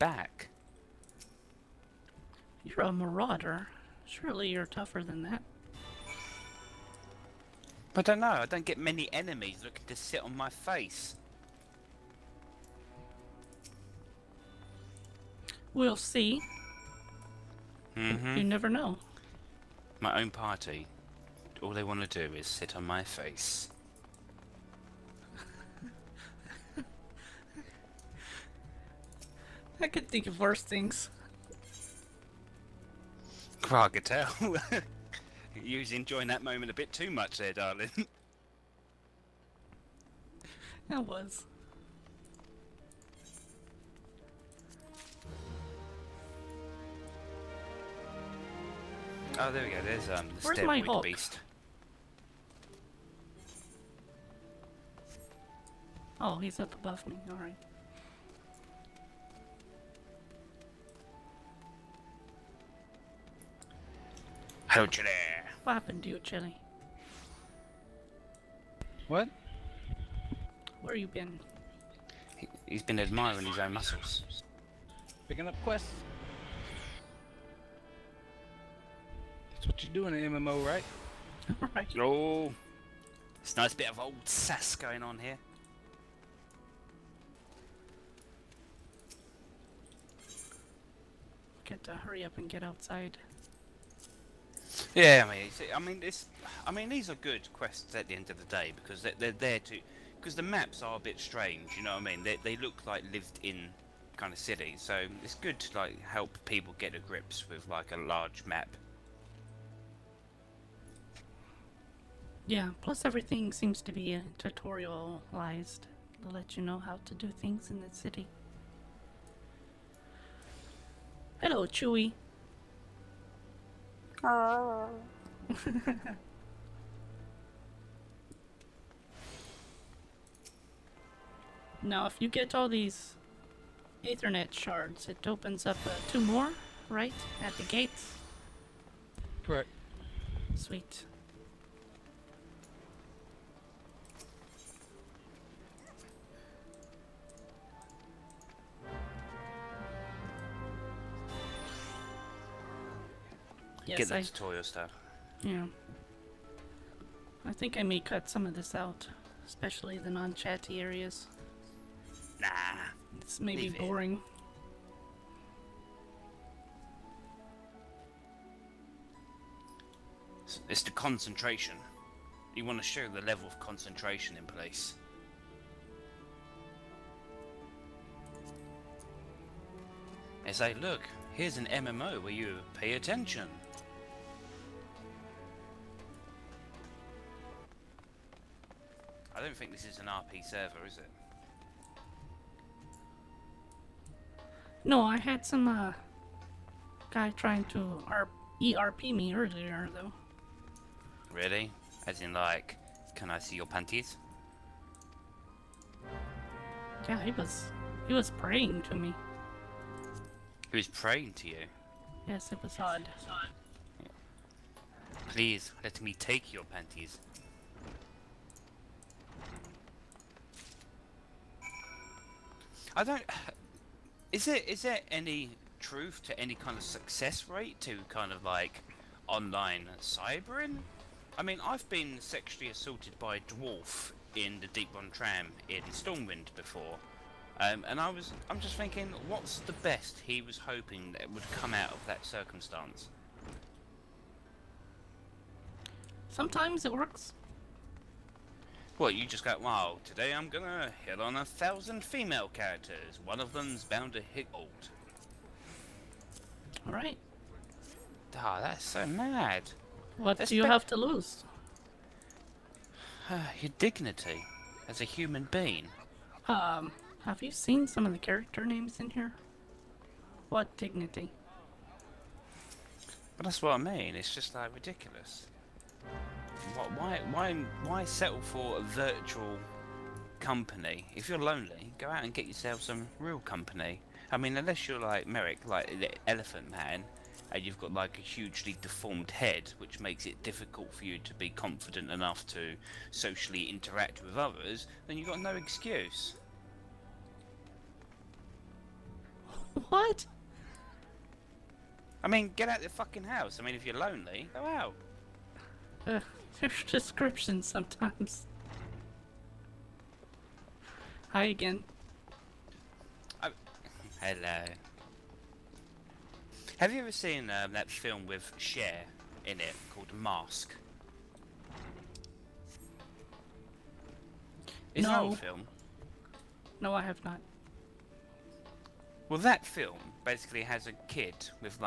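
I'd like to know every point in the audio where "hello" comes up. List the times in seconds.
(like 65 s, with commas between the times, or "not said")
64 s, 121 s, 314 s.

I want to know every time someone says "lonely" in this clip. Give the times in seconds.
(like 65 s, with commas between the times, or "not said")
281 s, 303 s.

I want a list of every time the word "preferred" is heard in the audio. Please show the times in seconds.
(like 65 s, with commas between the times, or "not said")
not said.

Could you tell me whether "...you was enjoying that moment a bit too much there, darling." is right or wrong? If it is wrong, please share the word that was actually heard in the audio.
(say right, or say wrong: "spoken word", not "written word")
right.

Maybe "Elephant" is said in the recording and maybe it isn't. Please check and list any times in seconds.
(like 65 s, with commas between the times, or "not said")
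286 s.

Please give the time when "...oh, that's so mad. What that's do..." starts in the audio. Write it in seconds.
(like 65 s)
258 s.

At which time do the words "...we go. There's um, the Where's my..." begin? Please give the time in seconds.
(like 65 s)
49 s.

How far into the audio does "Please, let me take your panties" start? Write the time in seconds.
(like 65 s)
215 s.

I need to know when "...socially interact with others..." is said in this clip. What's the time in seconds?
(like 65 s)
293 s.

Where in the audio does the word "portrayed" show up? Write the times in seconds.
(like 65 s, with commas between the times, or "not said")
not said.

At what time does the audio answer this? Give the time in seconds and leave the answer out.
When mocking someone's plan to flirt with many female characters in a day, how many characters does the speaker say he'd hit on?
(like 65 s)
251 s.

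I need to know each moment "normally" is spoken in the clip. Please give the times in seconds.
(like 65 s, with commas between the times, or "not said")
not said.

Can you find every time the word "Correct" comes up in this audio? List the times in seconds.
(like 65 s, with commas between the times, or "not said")
139 s.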